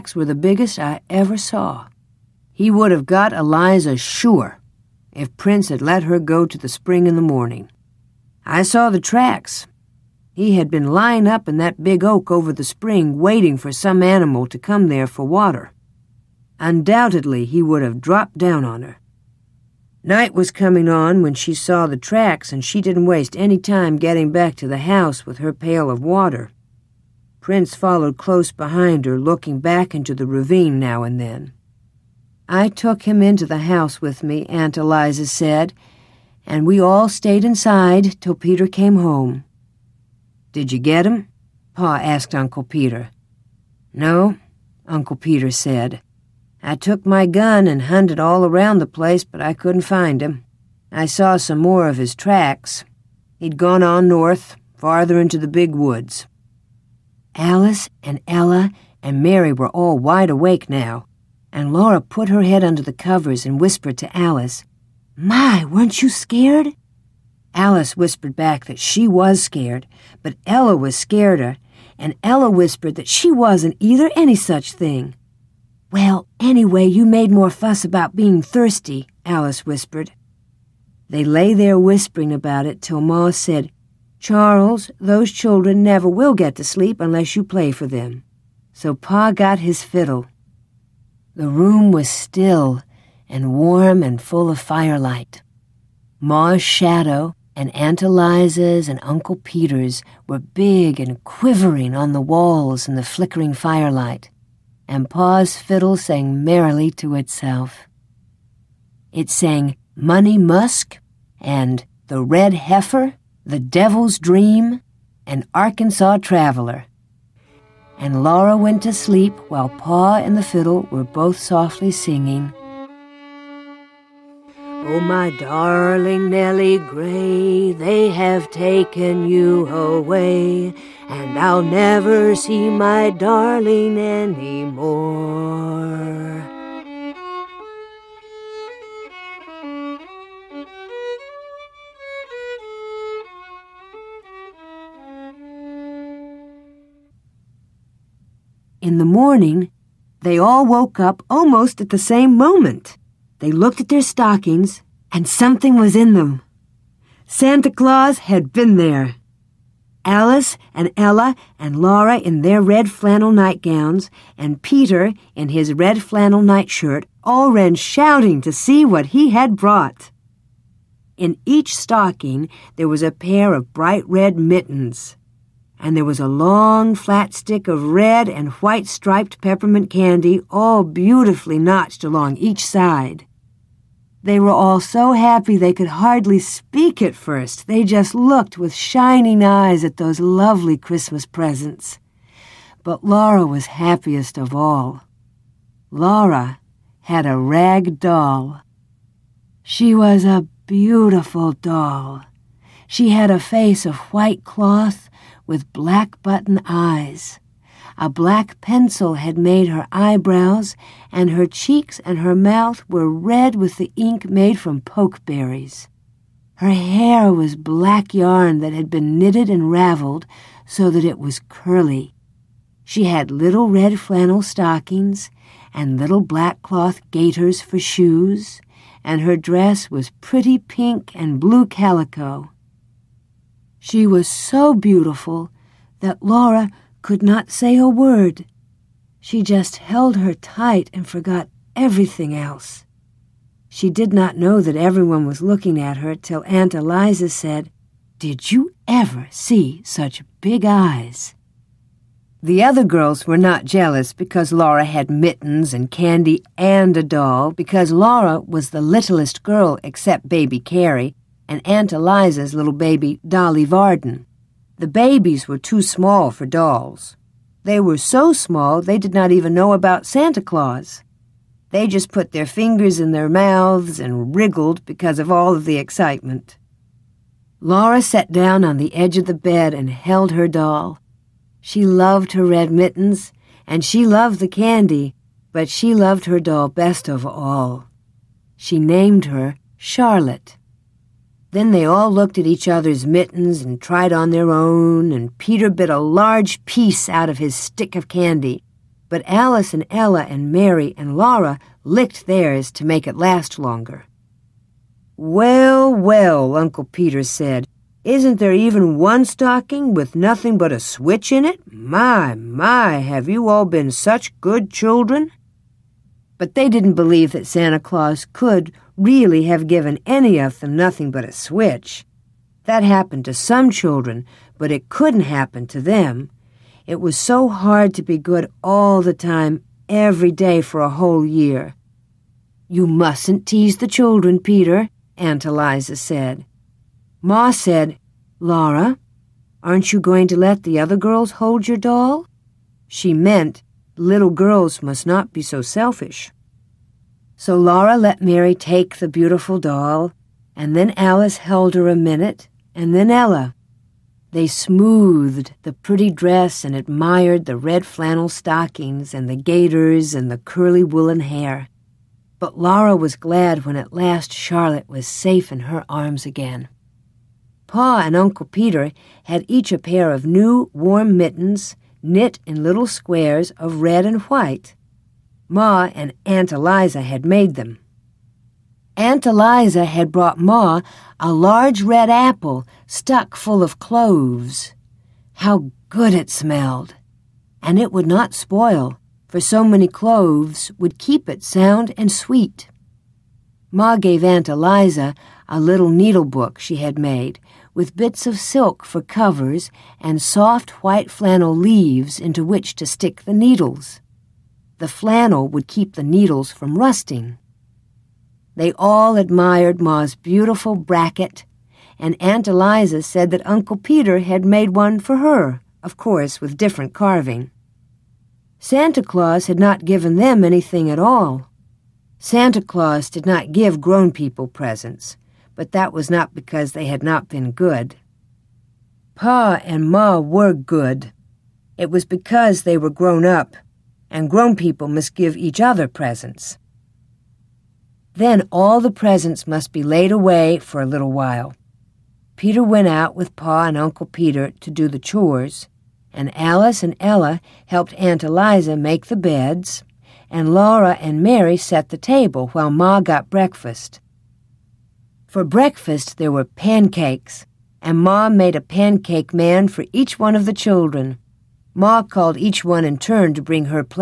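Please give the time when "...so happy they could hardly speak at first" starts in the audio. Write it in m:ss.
3:04.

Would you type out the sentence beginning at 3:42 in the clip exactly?
She had little red flannel stockings and little black cloth gaiters for shoes, and her dress was pretty pink and blue calico.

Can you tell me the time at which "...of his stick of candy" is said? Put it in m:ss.
4:57.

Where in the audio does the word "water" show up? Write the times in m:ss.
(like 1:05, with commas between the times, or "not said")
0:15, 0:26.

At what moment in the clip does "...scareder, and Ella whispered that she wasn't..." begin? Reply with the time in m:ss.
1:10.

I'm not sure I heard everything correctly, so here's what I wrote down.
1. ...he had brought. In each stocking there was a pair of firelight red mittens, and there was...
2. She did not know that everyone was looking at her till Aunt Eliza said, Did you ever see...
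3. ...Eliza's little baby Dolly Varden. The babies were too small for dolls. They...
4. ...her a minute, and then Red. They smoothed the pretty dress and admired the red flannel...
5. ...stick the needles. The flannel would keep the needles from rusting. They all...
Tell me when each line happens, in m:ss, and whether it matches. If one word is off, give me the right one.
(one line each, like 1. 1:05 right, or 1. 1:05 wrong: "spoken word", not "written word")
1. 2:49 wrong: "bright", not "firelight"
2. 4:03 right
3. 4:21 right
4. 5:51 wrong: "Ella", not "Red"
5. 6:42 right.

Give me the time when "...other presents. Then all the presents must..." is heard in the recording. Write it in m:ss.
7:15.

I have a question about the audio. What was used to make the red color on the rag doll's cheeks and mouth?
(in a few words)
Pokeberries.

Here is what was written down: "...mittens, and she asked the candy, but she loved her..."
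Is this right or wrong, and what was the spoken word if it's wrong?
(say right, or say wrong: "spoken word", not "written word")
wrong: "loved", not "asked".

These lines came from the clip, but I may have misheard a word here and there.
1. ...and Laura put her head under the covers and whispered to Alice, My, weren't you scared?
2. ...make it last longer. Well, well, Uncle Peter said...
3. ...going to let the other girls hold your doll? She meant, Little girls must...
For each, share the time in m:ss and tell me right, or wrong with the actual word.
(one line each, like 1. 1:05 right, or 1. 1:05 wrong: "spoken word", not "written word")
1. 1:01 right
2. 5:02 right
3. 5:39 right.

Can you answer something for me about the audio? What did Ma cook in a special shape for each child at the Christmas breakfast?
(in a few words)
A pancake man.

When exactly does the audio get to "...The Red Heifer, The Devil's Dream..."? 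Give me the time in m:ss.
1:52.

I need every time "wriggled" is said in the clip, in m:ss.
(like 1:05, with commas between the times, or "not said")
4:34.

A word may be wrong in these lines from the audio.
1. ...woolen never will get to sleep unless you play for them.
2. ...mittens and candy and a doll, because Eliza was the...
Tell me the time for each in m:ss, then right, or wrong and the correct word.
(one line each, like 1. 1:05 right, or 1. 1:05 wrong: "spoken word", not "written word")
1. 1:25 wrong: "children", not "woolen"
2. 4:15 wrong: "Laura", not "Eliza".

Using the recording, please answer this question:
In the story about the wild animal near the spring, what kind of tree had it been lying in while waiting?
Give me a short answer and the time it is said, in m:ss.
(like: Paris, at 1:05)
Big oak, at 0:11.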